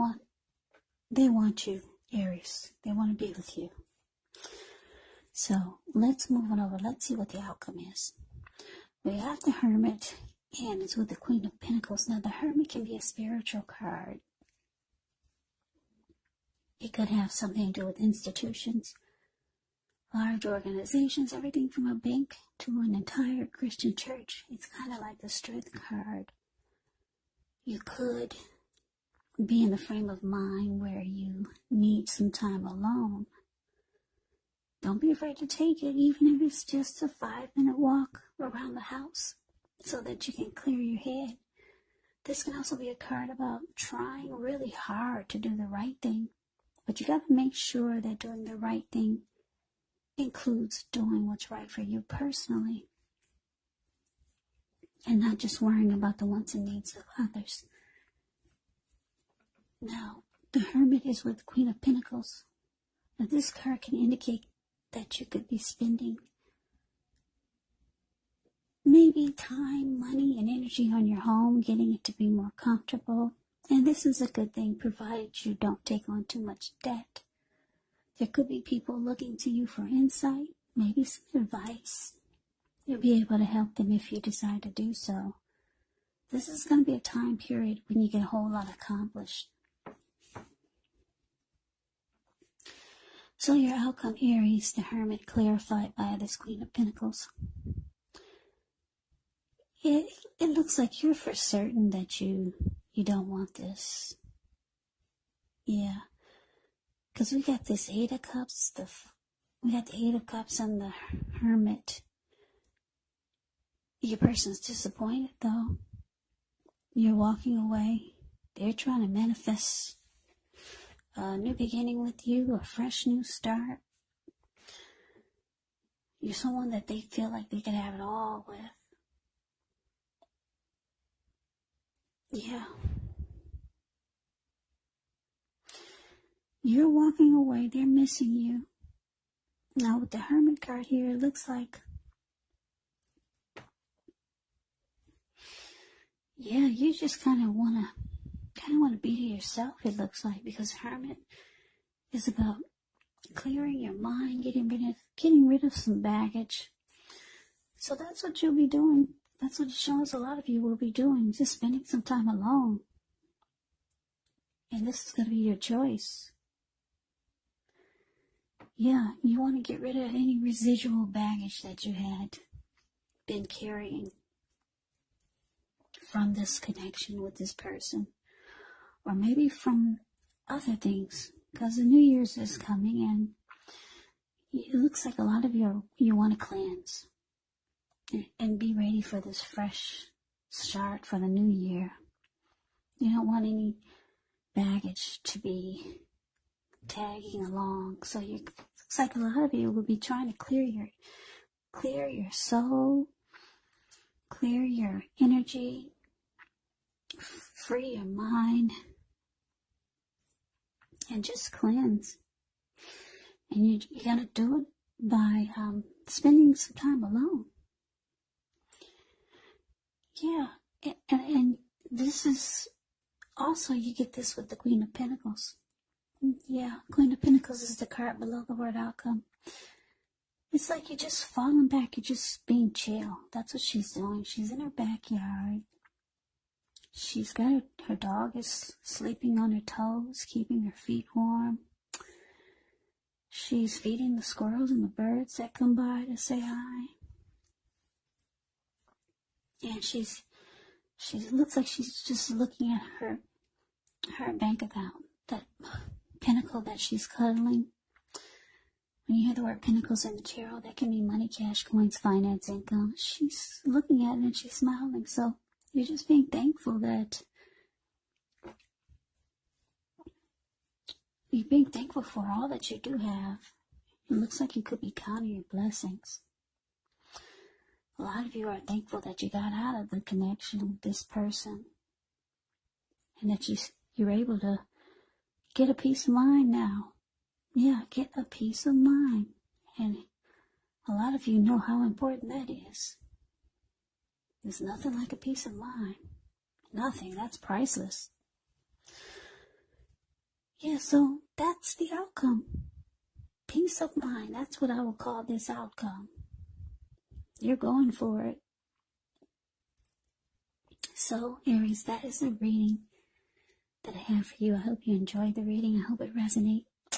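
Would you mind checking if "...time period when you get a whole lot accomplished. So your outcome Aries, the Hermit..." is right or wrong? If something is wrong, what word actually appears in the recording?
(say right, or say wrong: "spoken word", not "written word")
right.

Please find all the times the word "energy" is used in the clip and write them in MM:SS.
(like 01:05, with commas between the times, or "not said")
01:10, 03:25.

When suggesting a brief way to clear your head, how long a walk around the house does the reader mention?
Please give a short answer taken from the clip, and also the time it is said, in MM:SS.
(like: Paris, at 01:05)
5 minutes, at 00:37.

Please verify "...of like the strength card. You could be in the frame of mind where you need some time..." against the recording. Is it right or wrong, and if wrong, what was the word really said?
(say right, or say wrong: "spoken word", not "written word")
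right.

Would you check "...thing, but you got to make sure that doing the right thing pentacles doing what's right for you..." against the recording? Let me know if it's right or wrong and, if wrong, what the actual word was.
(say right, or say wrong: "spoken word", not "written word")
wrong: "includes", not "pentacles".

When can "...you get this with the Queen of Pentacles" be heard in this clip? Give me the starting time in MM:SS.
03:43.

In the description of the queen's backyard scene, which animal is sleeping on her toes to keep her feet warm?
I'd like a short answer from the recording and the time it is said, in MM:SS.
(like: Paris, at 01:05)
Dog, at 03:57.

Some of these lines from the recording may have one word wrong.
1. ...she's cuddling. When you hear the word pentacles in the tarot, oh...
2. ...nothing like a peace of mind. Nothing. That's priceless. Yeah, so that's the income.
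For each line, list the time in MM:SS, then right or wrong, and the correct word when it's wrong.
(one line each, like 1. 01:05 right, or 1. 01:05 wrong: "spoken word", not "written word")
1. 04:16 right
2. 04:54 wrong: "outcome", not "income".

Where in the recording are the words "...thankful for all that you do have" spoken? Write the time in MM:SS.
04:31.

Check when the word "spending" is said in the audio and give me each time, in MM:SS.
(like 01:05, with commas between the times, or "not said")
01:05, 02:41, 03:36.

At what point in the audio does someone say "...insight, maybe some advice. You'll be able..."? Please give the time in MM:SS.
01:19.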